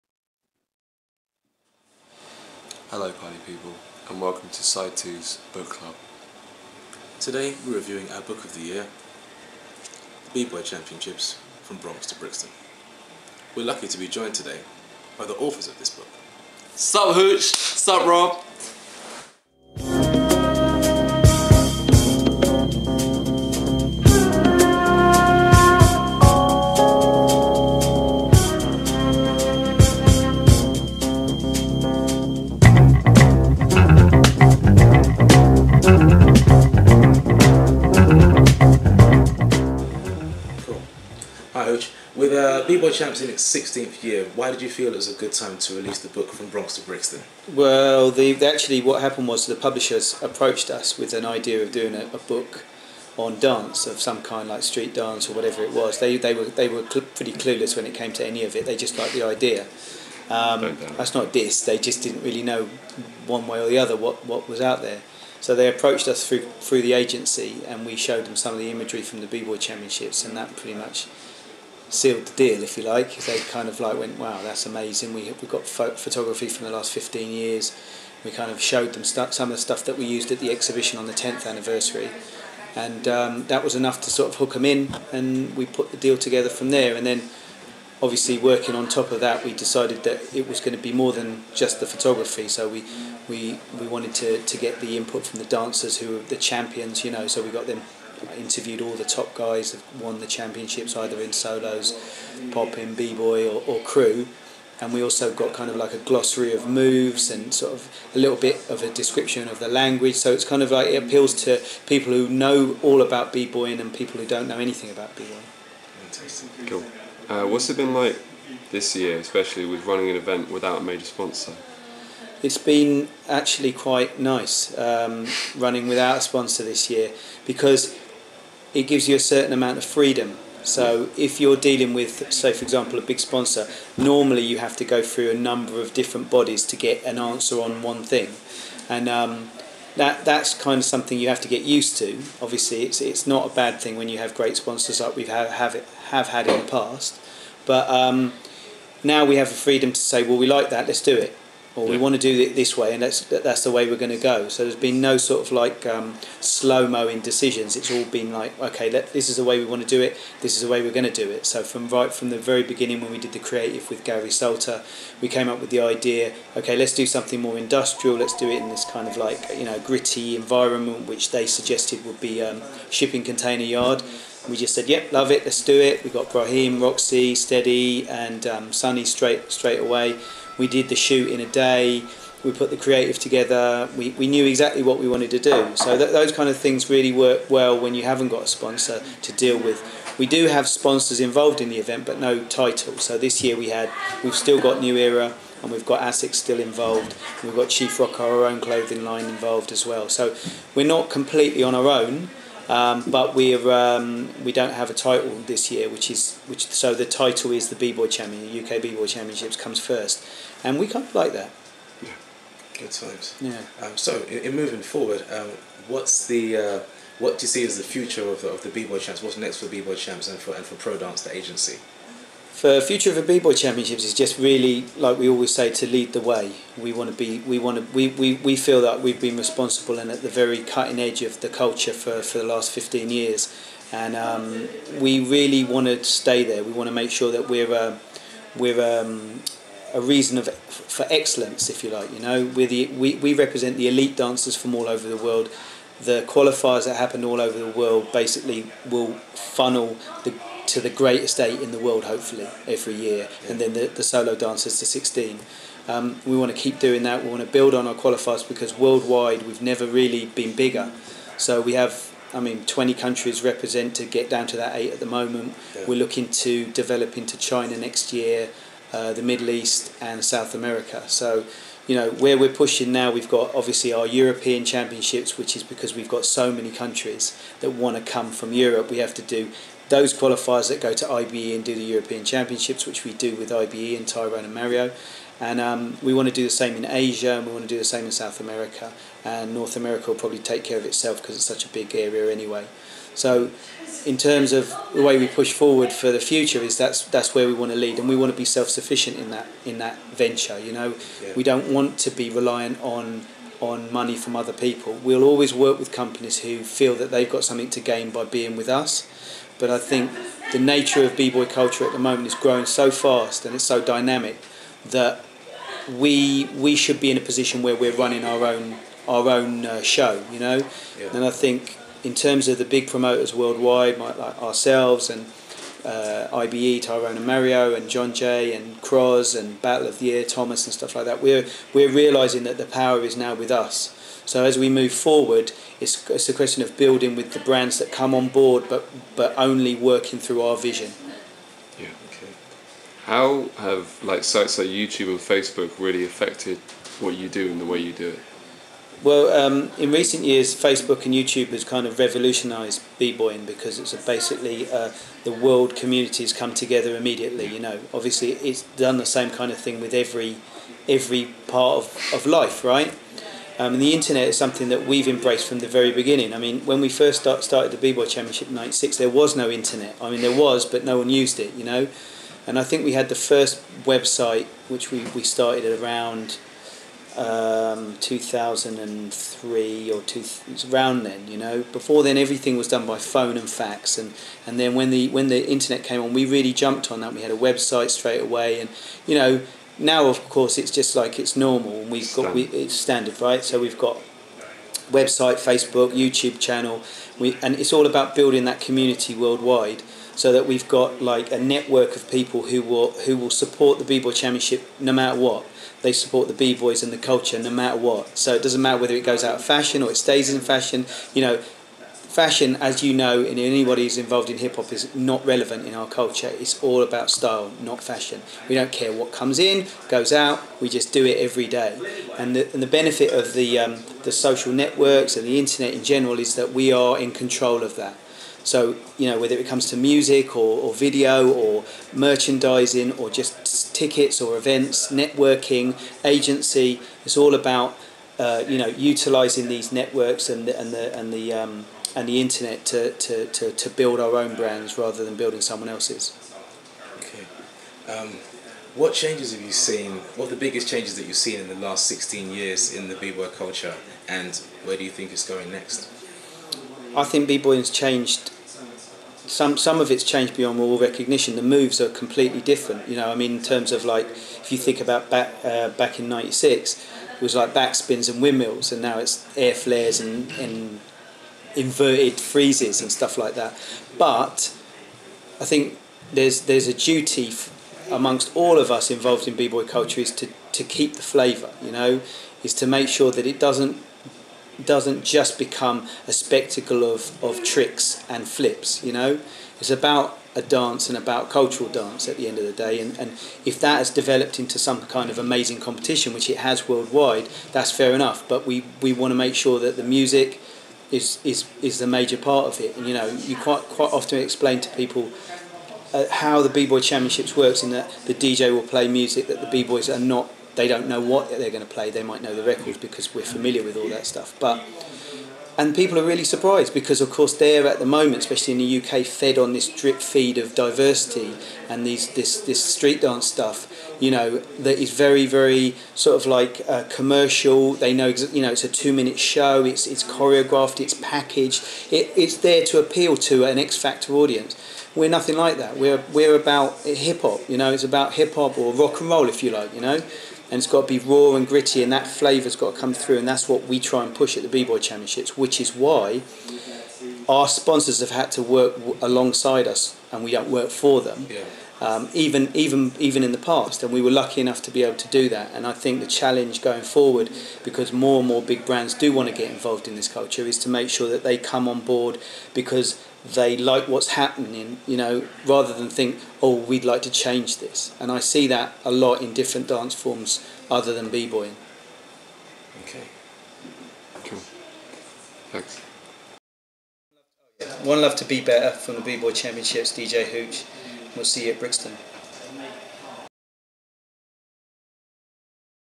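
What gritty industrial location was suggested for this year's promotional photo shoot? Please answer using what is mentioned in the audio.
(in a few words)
Shipping container yard.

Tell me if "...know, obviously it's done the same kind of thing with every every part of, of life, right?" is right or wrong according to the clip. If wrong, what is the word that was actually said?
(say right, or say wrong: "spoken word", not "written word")
right.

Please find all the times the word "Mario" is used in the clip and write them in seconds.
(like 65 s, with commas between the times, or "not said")
284 s, 327 s.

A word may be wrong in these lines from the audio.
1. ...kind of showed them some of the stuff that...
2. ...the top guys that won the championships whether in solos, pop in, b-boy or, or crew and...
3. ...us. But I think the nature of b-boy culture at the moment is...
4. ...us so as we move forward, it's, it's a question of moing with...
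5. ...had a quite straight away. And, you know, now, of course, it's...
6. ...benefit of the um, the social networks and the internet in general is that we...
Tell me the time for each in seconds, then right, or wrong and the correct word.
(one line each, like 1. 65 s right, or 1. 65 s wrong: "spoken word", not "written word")
1. 78 s right
2. 98 s wrong: "either", not "whether"
3. 308 s right
4. 333 s wrong: "building", not "moing"
5. 387 s wrong: "website", not "quite"
6. 422 s right.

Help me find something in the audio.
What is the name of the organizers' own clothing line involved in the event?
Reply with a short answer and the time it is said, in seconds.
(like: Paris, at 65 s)
Chief Rock, at 197 s.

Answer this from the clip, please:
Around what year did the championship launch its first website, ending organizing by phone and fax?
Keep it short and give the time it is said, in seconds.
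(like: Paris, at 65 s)
2003, at 378 s.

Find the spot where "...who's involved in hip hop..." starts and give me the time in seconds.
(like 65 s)
413 s.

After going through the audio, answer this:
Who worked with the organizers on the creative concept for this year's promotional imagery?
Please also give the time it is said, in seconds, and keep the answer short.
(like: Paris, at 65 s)
Gary Salter, at 164 s.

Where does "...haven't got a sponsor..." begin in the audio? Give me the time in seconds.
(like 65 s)
188 s.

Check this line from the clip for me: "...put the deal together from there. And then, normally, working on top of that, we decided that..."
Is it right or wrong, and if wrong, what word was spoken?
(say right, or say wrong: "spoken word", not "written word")
wrong: "obviously", not "normally".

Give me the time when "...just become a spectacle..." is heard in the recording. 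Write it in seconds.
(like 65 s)
485 s.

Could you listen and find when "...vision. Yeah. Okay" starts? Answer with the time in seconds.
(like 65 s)
340 s.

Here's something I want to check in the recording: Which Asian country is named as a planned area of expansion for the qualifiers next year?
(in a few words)
China.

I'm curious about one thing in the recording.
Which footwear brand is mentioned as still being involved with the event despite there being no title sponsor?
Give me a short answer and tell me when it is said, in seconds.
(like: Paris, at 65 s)
ASICS, at 196 s.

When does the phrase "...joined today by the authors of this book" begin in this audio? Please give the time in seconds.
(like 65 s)
14 s.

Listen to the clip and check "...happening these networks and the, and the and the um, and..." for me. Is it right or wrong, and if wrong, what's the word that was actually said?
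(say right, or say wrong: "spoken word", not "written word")
wrong: "utilizing", not "happening".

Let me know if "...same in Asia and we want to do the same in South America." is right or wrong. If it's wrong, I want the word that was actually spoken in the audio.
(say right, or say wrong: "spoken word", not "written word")
right.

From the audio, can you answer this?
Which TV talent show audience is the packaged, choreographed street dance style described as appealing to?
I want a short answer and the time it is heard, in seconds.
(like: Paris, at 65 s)
X Factor, at 533 s.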